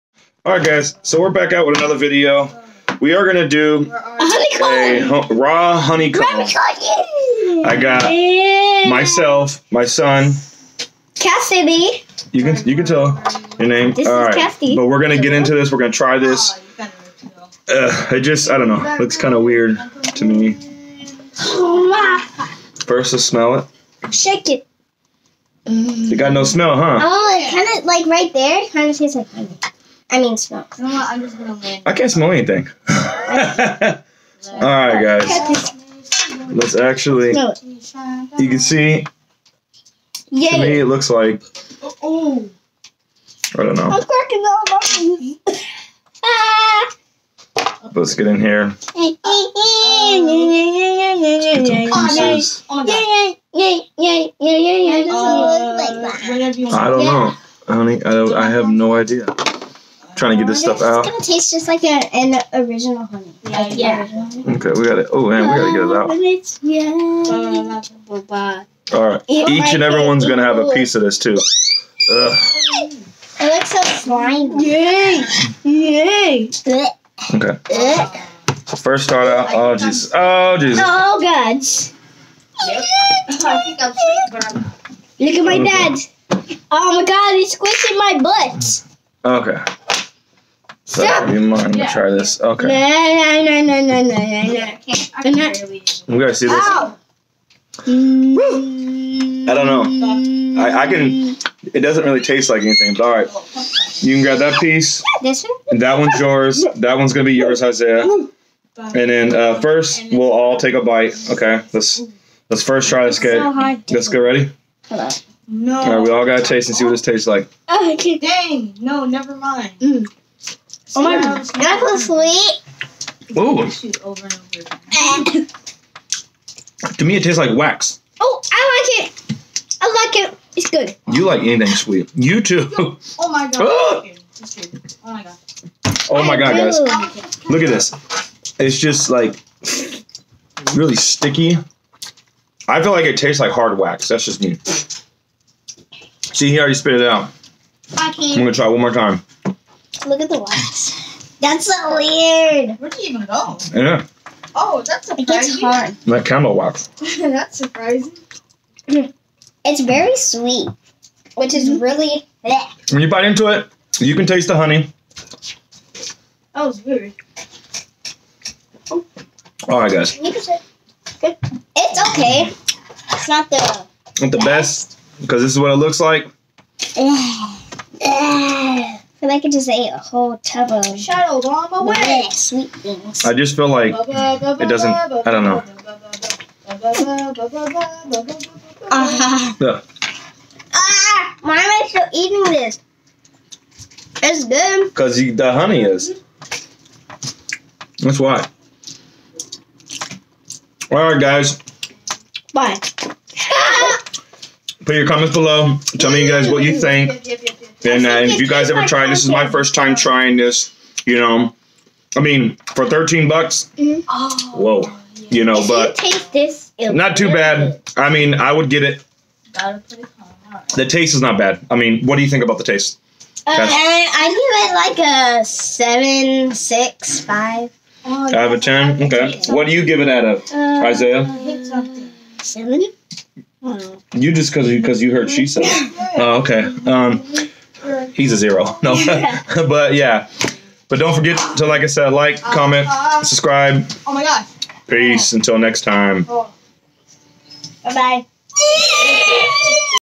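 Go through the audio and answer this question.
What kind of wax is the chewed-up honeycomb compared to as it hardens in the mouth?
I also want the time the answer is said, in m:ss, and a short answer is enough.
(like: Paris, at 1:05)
camel wax, at 2:36.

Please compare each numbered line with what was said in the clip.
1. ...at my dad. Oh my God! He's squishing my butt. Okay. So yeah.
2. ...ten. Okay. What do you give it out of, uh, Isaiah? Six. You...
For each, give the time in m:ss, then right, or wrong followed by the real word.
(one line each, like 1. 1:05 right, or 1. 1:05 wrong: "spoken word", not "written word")
1. 1:25 right
2. 3:48 wrong: "Seven", not "Six".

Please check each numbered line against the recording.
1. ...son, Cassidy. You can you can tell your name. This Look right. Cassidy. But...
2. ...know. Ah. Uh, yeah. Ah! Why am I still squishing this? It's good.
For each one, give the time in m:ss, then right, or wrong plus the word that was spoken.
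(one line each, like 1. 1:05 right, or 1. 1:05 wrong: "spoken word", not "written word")
1. 0:09 wrong: "All", not "Look"
2. 3:05 wrong: "eating", not "squishing".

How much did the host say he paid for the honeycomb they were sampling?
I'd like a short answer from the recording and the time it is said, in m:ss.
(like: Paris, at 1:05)
$13, at 3:32.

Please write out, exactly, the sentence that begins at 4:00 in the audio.
But don't forget to, like I said, like, uh, comment, uh, subscribe.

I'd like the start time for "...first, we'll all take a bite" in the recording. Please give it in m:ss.
1:49.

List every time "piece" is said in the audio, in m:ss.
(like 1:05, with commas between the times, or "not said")
0:52, 1:10, 1:44.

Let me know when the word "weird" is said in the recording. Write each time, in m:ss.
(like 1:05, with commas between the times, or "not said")
0:19, 2:31, 2:46.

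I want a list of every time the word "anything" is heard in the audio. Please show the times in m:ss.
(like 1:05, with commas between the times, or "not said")
0:32, 1:42, 2:11.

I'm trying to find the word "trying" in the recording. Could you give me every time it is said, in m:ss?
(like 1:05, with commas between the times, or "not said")
1:00, 3:29.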